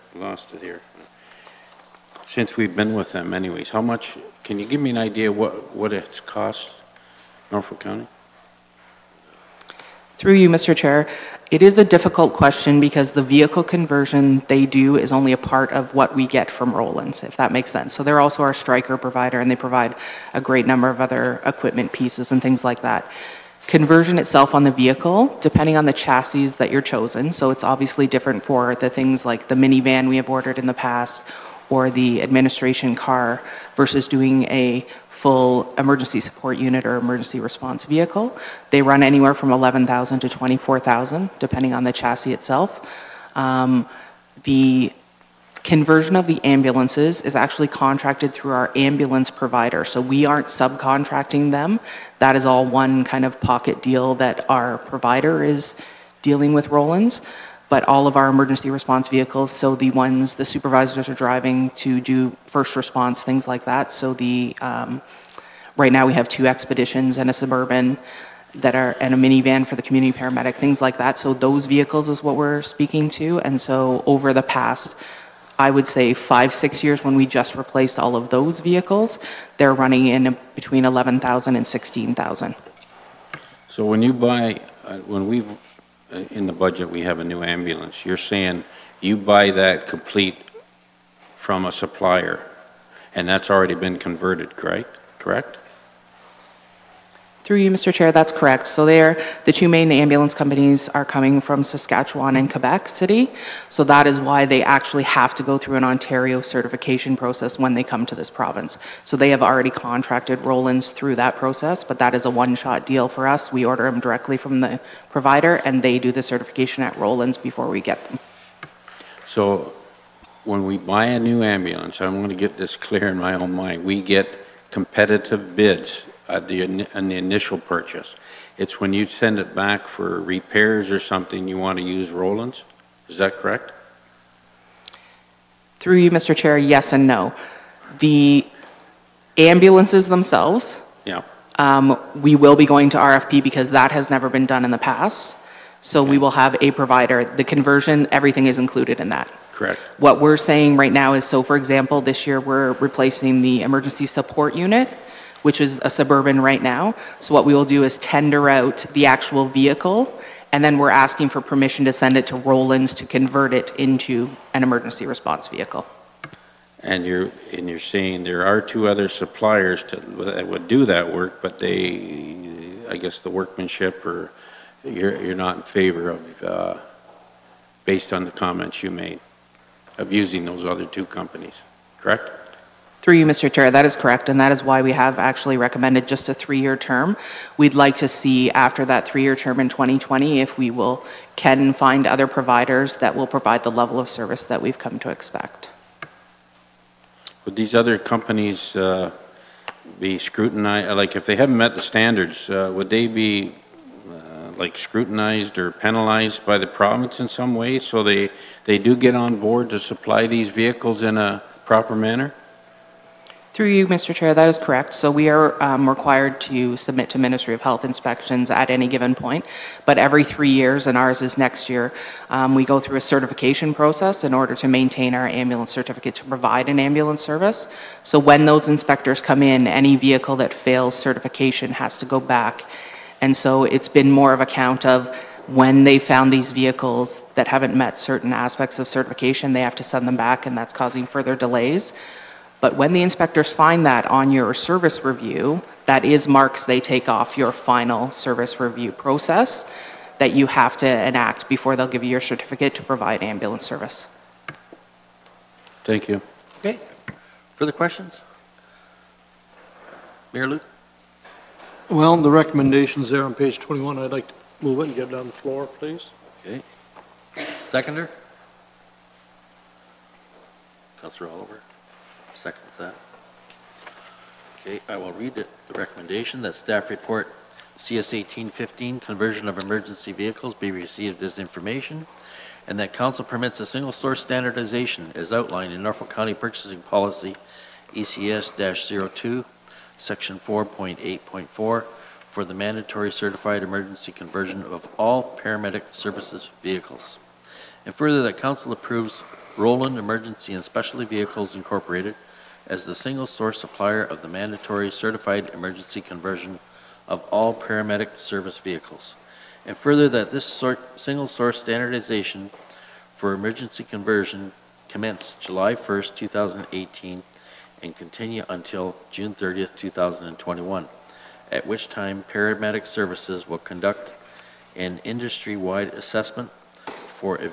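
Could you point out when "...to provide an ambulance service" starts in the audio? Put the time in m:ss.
3:46.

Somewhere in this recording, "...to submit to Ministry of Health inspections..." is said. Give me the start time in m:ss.
3:36.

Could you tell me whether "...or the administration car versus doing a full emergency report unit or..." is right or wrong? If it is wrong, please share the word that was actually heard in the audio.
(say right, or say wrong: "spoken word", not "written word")
wrong: "support", not "report".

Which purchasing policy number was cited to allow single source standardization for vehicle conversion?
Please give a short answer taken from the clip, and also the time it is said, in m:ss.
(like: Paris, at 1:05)
ECS-02, at 4:47.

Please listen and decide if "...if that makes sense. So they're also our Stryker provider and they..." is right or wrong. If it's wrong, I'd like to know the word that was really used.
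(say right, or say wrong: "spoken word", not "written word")
right.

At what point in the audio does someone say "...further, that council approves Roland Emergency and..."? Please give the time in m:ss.
4:57.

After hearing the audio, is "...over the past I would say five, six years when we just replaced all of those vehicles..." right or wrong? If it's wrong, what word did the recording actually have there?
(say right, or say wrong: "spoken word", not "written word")
right.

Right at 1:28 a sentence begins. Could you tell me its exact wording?
You're saying you buy that complete from a supplier, and that's already been converted, correct?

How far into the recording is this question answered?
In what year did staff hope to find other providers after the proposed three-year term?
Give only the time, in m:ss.
3:09.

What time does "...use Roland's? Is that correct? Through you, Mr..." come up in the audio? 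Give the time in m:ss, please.
2:11.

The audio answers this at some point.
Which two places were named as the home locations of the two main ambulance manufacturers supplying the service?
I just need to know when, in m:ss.
1:41.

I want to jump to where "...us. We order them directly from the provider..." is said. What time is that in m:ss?
1:53.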